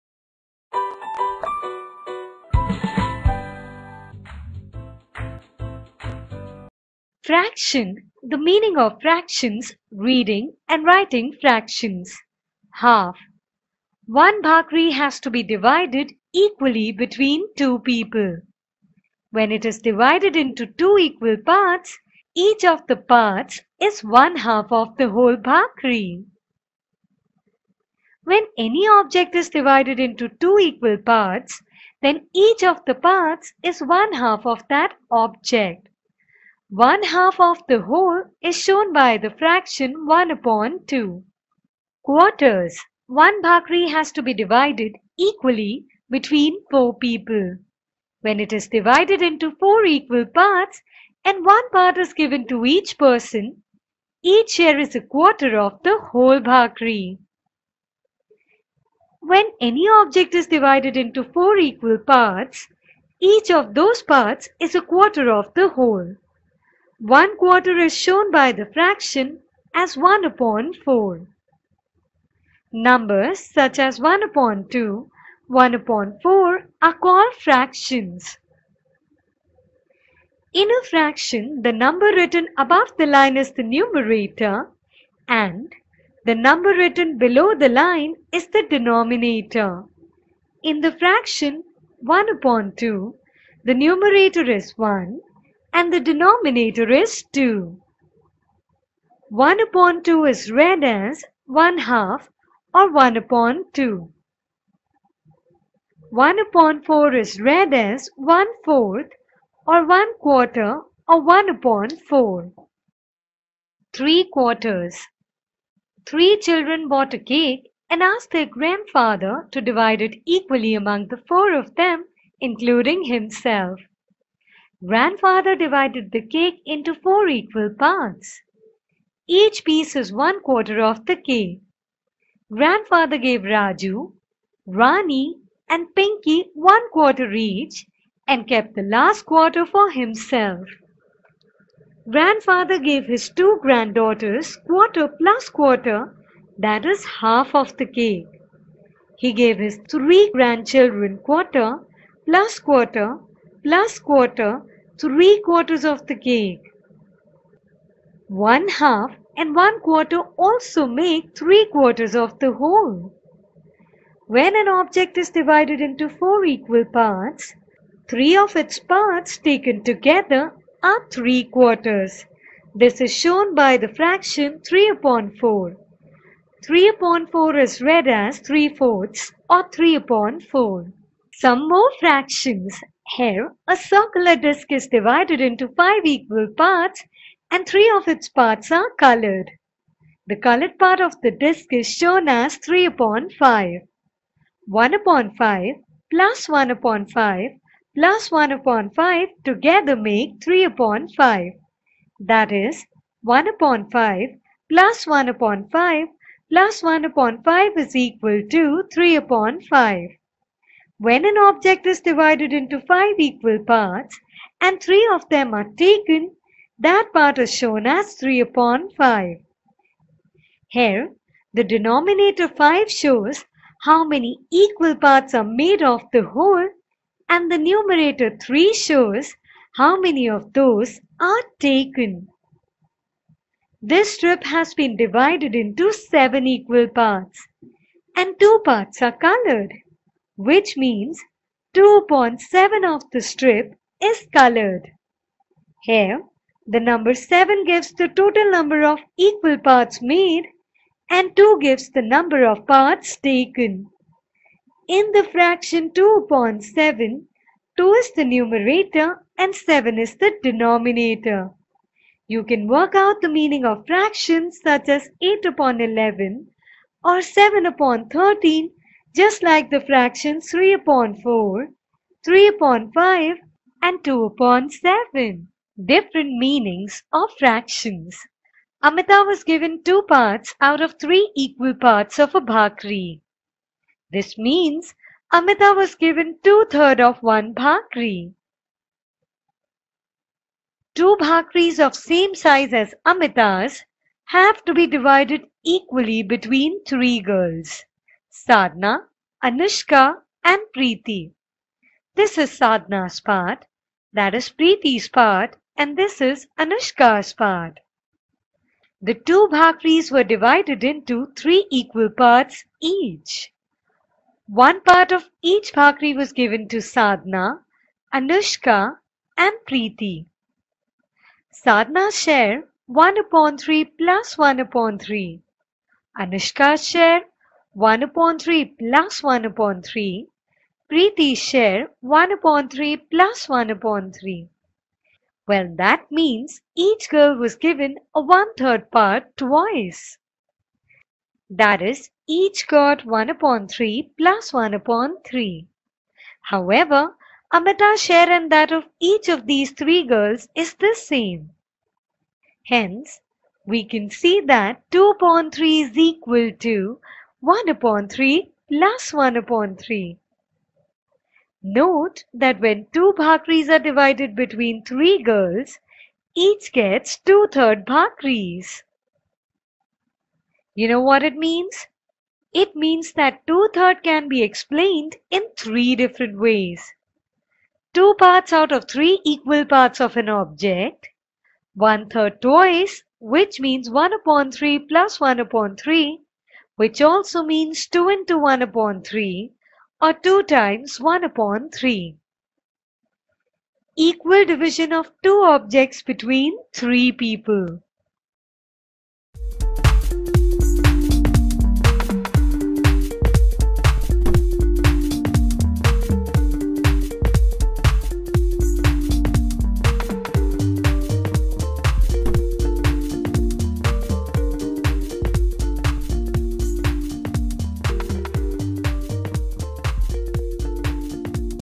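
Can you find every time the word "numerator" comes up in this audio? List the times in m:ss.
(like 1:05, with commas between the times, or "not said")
1:23, 1:33, 3:47, 4:18.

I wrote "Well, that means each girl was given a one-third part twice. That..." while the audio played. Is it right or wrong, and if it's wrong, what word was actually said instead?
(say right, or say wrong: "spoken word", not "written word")
right.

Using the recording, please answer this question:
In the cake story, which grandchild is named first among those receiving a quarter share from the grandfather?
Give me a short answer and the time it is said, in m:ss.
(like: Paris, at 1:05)
Raju, at 2:13.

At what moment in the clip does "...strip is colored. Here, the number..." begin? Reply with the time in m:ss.
4:03.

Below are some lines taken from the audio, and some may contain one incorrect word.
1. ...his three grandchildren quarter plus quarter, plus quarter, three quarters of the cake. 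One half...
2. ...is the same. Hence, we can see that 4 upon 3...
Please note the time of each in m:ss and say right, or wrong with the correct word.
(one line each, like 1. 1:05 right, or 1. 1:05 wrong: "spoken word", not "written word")
1. 2:29 right
2. 5:50 wrong: "2", not "4".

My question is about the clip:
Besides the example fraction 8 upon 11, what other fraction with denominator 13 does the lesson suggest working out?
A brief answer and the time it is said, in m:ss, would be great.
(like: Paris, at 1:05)
7/13, at 4:27.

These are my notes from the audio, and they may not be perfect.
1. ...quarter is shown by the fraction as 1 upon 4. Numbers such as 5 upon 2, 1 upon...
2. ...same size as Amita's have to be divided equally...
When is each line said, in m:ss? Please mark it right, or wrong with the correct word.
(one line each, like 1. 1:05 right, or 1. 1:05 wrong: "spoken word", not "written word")
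1. 1:07 wrong: "1", not "5"
2. 4:51 right.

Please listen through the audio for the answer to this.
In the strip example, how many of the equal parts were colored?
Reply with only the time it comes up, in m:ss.
3:58.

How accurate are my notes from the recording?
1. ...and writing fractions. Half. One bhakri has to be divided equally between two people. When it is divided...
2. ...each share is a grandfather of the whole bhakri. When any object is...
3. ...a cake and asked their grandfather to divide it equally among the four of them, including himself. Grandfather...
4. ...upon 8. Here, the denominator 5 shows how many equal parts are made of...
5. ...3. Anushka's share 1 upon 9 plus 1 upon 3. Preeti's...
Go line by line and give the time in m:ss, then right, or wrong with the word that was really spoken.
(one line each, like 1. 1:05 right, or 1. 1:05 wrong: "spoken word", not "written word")
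1. 0:10 right
2. 0:54 wrong: "quarter", not "grandfather"
3. 1:57 right
4. 3:38 wrong: "5", not "8"
5. 5:24 wrong: "3", not "9".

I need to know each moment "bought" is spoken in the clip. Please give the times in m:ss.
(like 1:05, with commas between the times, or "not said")
1:56.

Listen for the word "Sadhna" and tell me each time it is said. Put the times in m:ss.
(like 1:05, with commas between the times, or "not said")
4:58, 5:02, 5:16, 5:21.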